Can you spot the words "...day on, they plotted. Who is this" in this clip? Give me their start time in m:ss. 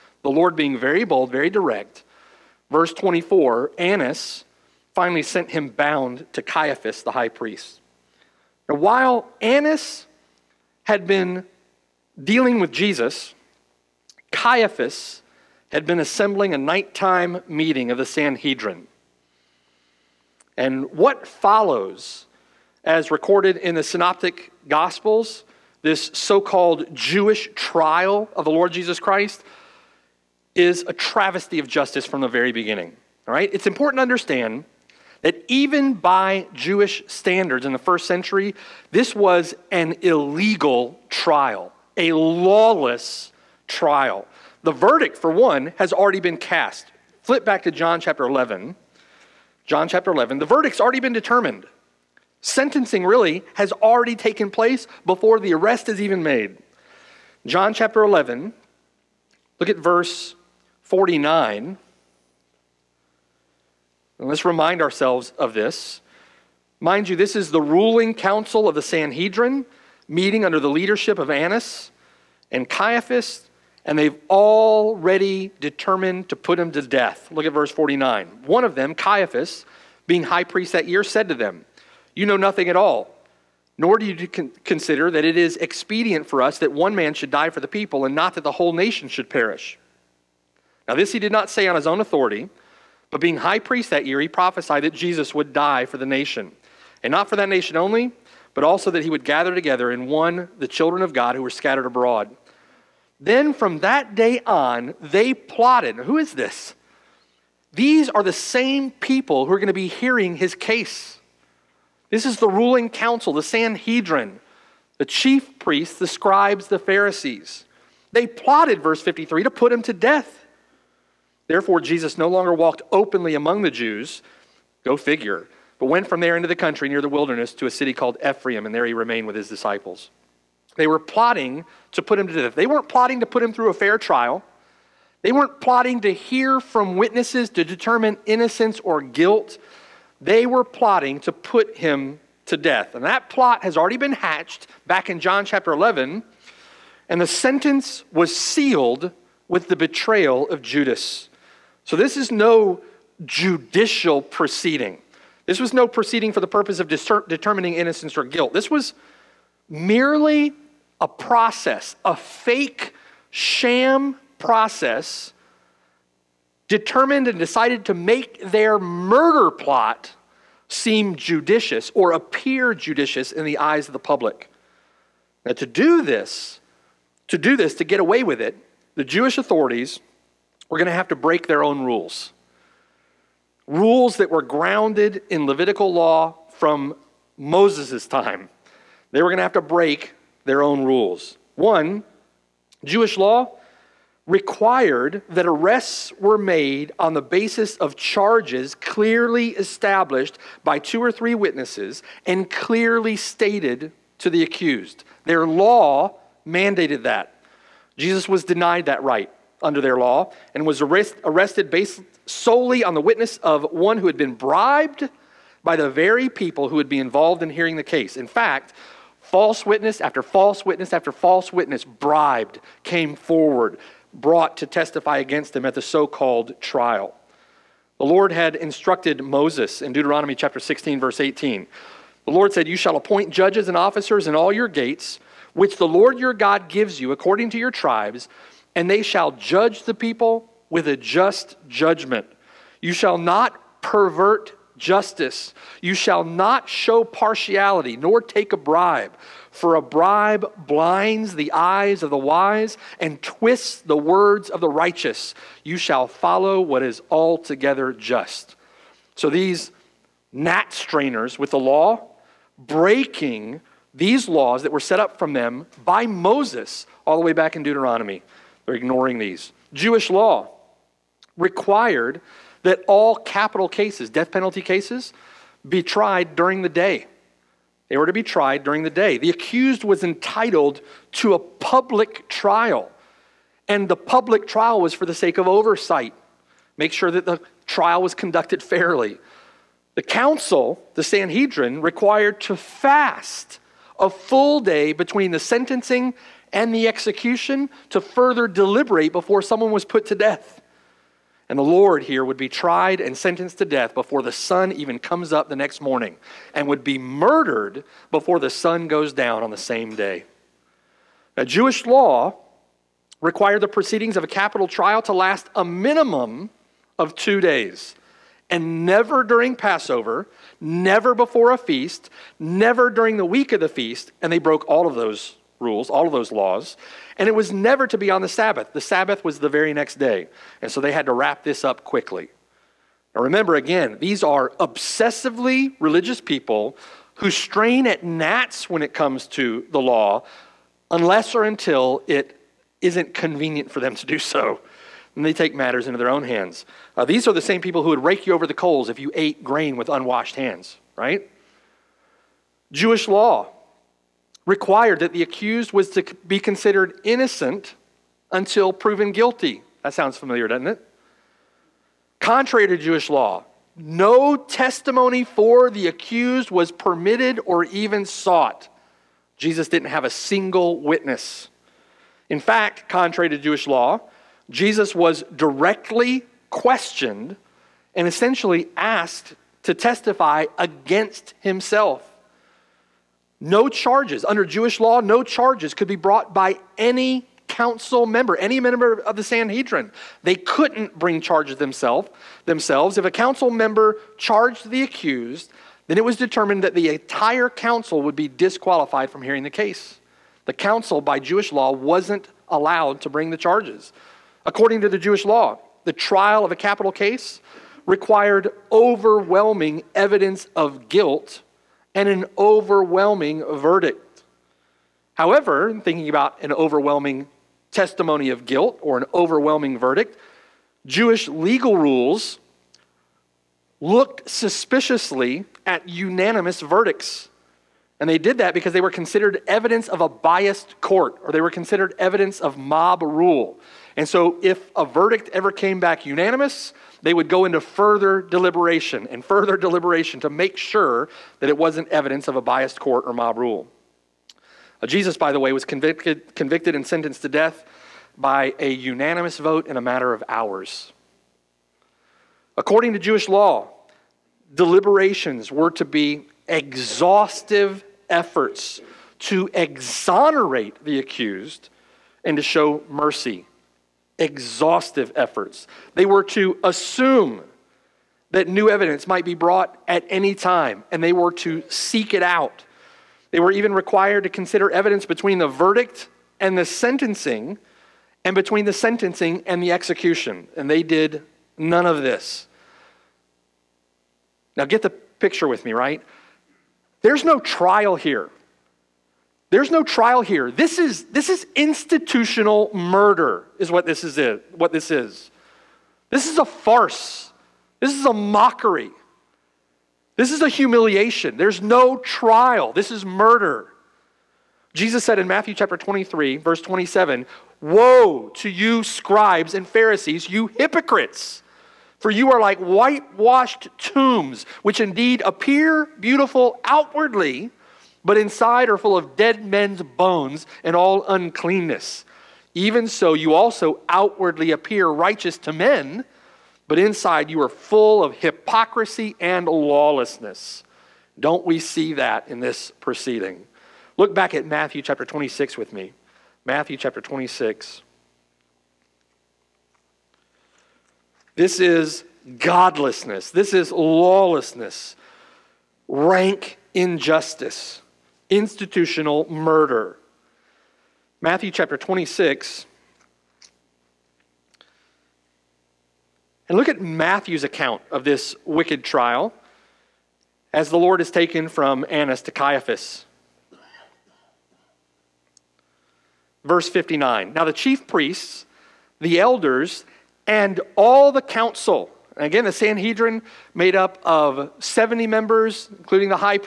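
1:44.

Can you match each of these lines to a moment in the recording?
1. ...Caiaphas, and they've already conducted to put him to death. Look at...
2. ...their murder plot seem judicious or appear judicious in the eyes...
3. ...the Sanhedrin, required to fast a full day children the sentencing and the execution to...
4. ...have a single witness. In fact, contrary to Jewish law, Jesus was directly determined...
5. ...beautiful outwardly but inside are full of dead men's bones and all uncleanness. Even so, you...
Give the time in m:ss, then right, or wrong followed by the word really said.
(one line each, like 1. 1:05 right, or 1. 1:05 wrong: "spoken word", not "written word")
1. 1:12 wrong: "determined", not "conducted"
2. 2:48 right
3. 4:50 wrong: "between", not "children"
4. 6:09 wrong: "questioned", not "determined"
5. 8:35 right.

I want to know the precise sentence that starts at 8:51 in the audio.
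Don't we see that in this proceeding?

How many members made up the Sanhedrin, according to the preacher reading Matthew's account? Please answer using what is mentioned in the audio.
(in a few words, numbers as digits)
70.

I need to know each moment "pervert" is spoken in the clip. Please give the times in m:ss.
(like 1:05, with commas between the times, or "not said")
4:03.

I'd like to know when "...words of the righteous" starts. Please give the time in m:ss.
4:13.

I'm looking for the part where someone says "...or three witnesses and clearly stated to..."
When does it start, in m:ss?
3:21.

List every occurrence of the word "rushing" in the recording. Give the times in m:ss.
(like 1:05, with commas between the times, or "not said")
not said.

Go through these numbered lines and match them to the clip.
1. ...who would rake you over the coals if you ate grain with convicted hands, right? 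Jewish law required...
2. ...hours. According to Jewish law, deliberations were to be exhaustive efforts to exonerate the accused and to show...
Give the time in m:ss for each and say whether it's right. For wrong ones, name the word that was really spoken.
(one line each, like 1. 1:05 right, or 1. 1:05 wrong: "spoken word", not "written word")
1. 5:47 wrong: "unwashed", not "convicted"
2. 7:30 right.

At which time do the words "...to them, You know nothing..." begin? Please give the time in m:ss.
1:21.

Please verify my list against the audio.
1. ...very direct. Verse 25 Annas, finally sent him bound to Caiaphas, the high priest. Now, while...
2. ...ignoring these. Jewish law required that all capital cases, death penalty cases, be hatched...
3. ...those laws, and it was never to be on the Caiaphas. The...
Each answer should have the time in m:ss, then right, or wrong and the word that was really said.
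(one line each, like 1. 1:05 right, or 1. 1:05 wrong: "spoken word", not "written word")
1. 0:01 wrong: "24", not "25"
2. 4:28 wrong: "tried", not "hatched"
3. 5:26 wrong: "Sabbath", not "Caiaphas".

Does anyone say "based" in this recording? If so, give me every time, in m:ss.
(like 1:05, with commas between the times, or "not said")
3:31.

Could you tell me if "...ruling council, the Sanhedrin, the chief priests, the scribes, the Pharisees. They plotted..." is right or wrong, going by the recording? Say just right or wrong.
right.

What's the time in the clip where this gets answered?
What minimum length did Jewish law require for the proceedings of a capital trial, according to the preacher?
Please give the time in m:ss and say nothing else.
5:17.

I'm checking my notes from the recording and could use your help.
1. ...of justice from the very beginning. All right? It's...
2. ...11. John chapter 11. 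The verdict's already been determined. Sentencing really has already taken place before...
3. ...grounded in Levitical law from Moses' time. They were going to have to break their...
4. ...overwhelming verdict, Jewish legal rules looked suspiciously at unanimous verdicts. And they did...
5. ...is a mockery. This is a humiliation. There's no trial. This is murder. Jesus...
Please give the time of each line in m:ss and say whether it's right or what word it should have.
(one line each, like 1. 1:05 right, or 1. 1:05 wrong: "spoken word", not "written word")
1. 0:31 right
2. 0:48 right
3. 3:04 right
4. 6:59 right
5. 8:17 right.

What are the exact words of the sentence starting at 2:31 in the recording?
So this is no judicial proceeding.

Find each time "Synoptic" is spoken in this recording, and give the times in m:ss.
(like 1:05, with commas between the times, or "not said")
0:23.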